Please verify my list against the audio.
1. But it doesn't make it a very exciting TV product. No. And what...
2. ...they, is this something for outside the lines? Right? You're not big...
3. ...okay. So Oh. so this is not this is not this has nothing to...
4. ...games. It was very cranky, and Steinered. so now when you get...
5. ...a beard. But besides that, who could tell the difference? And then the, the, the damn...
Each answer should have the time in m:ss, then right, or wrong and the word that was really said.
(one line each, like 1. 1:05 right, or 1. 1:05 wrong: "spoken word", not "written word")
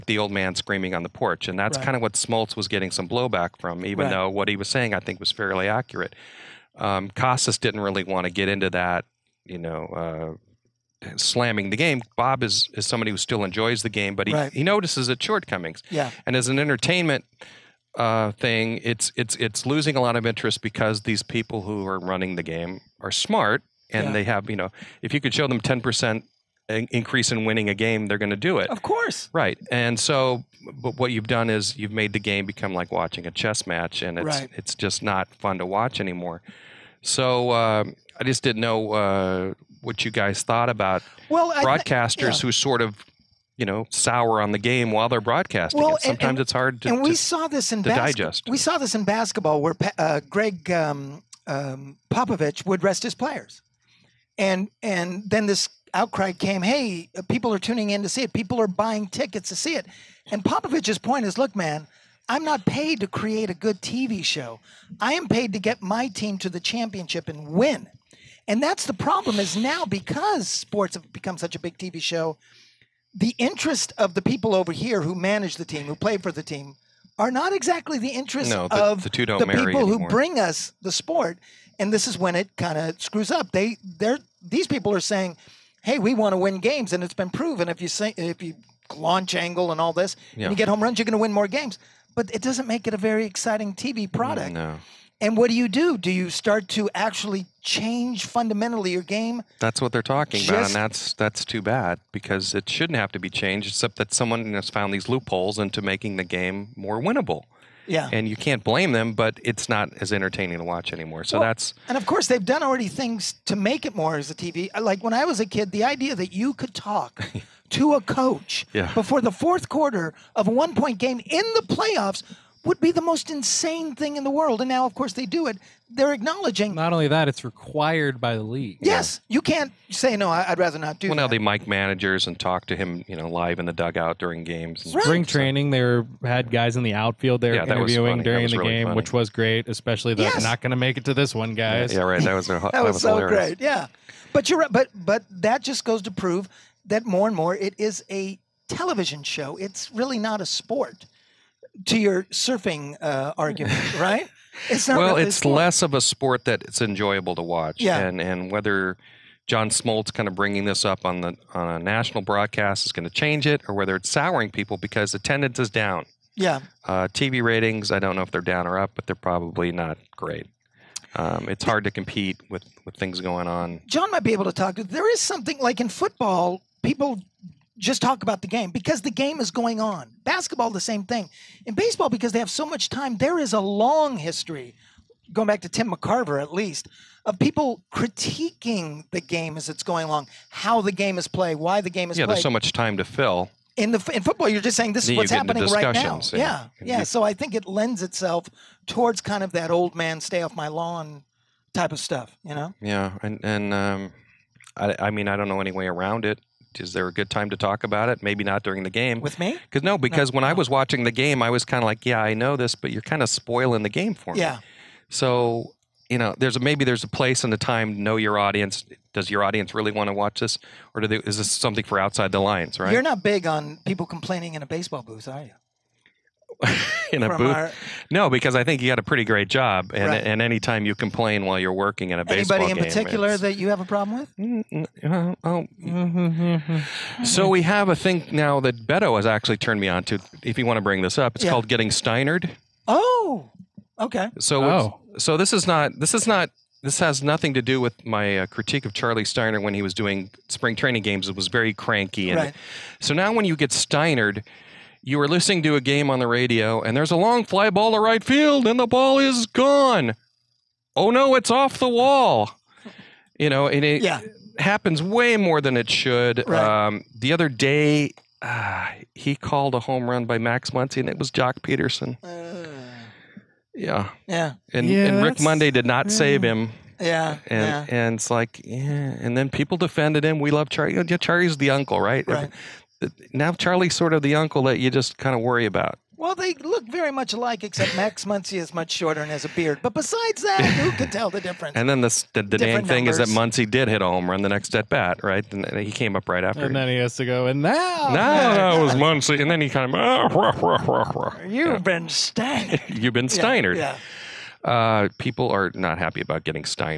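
1. 1:32 right
2. 3:41 right
3. 4:03 right
4. 4:11 wrong: "Right", not "Steinered"
5. 4:49 right.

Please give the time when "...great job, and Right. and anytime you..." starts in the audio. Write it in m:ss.
3:49.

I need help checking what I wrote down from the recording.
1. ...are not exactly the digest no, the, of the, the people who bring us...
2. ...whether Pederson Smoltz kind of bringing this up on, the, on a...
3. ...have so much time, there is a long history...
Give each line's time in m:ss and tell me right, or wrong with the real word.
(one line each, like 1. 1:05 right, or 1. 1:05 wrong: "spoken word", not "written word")
1. 1:17 wrong: "interest", not "digest"
2. 2:38 wrong: "John", not "Pederson"
3. 3:02 right.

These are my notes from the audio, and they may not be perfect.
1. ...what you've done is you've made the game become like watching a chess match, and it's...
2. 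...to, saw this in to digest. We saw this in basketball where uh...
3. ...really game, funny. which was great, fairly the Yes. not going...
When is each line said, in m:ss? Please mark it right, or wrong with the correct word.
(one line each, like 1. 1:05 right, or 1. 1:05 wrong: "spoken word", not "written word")
1. 0:30 right
2. 0:47 right
3. 2:18 wrong: "especially", not "fairly".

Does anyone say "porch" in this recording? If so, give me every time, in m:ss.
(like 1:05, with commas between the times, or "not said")
0:01.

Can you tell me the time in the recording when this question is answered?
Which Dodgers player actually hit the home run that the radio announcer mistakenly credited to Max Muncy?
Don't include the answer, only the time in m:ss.
4:31.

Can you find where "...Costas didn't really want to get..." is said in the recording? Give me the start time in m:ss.
0:07.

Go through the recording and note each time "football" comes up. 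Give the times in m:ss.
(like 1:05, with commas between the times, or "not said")
2:55, 3:14.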